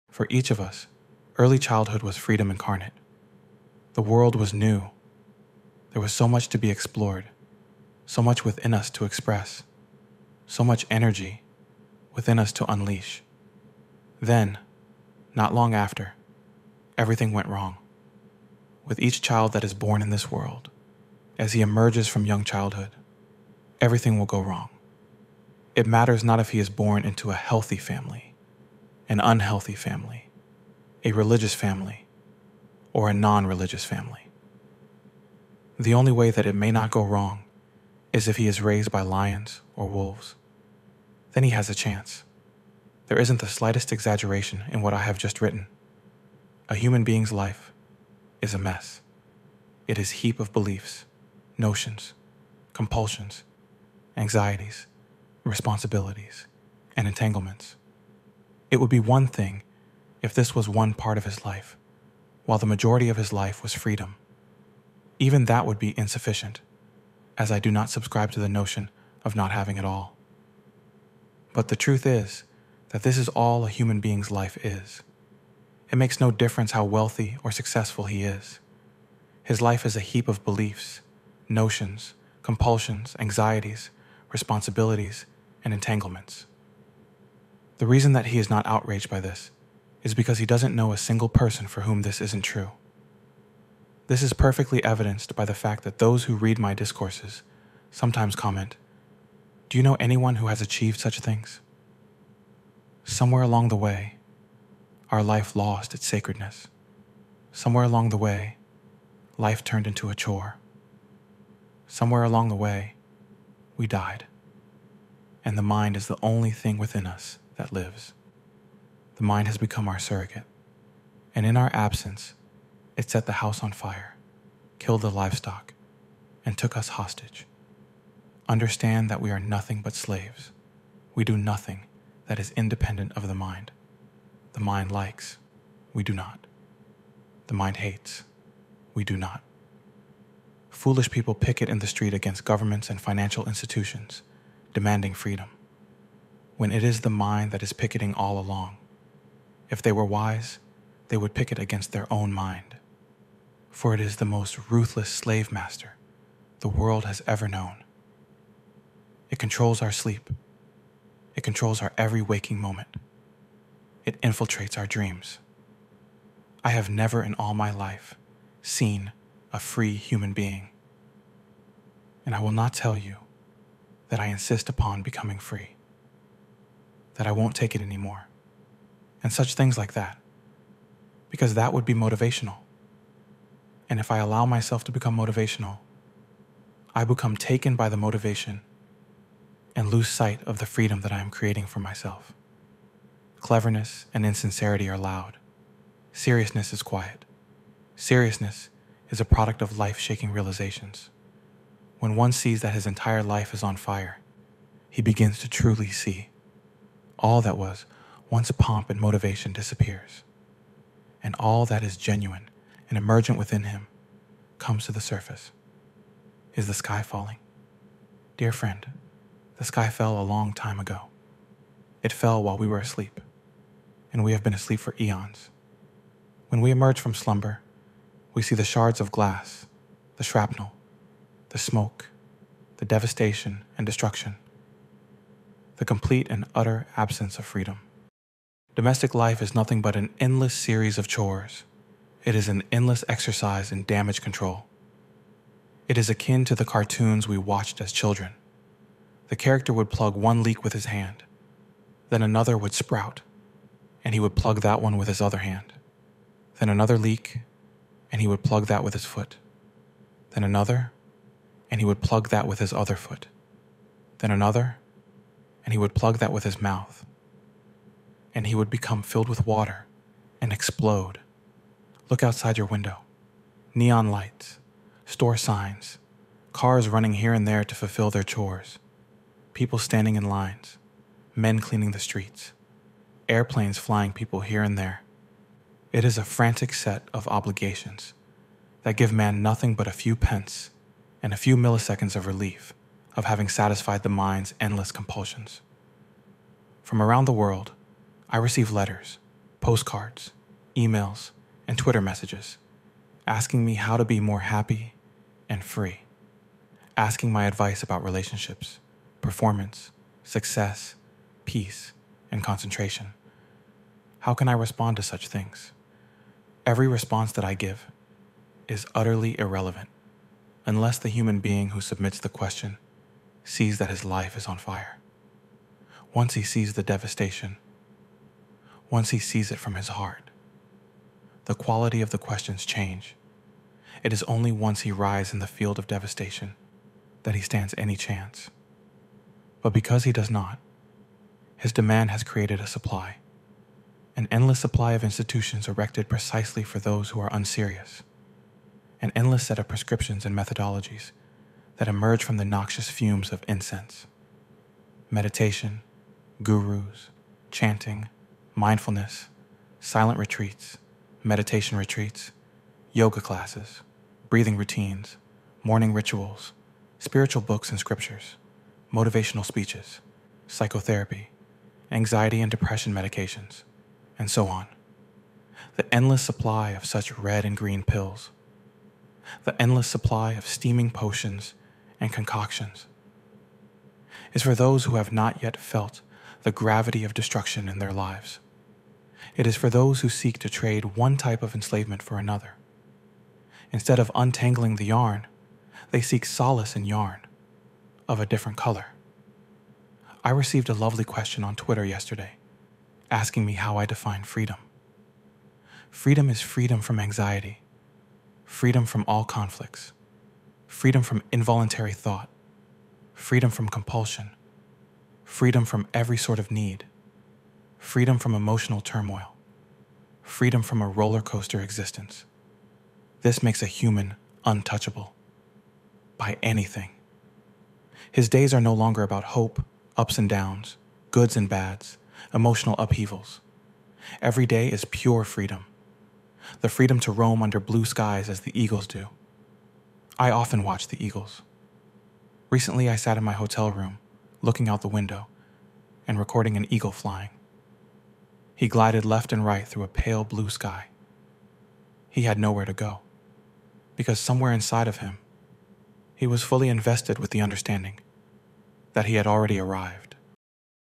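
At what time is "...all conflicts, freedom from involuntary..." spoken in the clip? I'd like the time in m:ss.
6:49.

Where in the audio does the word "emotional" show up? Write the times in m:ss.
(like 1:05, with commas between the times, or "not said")
6:58, 7:12.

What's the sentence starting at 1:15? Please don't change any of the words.
It makes no difference how wealthy or successful he is.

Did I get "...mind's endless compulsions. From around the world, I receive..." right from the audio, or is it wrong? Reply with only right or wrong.
right.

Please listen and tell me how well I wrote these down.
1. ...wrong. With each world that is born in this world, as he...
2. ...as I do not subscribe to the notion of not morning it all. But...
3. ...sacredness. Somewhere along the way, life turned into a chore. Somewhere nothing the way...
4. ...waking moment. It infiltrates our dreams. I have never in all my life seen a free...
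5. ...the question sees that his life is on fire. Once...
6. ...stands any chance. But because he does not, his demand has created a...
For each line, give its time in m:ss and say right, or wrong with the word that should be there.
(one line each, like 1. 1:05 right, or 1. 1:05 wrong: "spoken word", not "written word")
1. 0:17 wrong: "child", not "world"
2. 1:07 wrong: "having", not "morning"
3. 1:46 wrong: "along", not "nothing"
4. 2:42 right
5. 5:22 right
6. 5:37 right.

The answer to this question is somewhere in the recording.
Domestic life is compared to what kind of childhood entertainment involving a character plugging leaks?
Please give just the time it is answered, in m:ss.
4:06.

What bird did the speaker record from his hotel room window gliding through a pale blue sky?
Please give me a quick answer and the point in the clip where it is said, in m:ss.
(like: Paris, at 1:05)
eagle, at 7:26.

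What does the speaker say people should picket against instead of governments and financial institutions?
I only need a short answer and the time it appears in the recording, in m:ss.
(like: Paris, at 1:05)
their own mind, at 2:31.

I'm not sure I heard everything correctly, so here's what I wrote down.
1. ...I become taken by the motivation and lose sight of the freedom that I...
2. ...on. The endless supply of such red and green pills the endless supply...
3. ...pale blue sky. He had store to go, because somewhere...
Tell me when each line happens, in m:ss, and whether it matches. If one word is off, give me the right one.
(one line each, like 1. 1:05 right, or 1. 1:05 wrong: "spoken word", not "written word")
1. 3:06 right
2. 6:14 right
3. 7:29 wrong: "nowhere", not "store".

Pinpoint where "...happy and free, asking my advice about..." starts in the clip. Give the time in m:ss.
5:04.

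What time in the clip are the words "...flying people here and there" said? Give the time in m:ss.
4:43.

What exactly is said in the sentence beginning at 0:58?
It would be one thing if this was one part of his life, while the majority of his life was freedom.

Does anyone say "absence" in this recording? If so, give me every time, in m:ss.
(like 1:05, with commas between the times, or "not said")
2:01, 3:56.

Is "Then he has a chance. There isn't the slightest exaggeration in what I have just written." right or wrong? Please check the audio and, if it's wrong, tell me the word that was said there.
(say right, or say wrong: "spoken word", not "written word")
right.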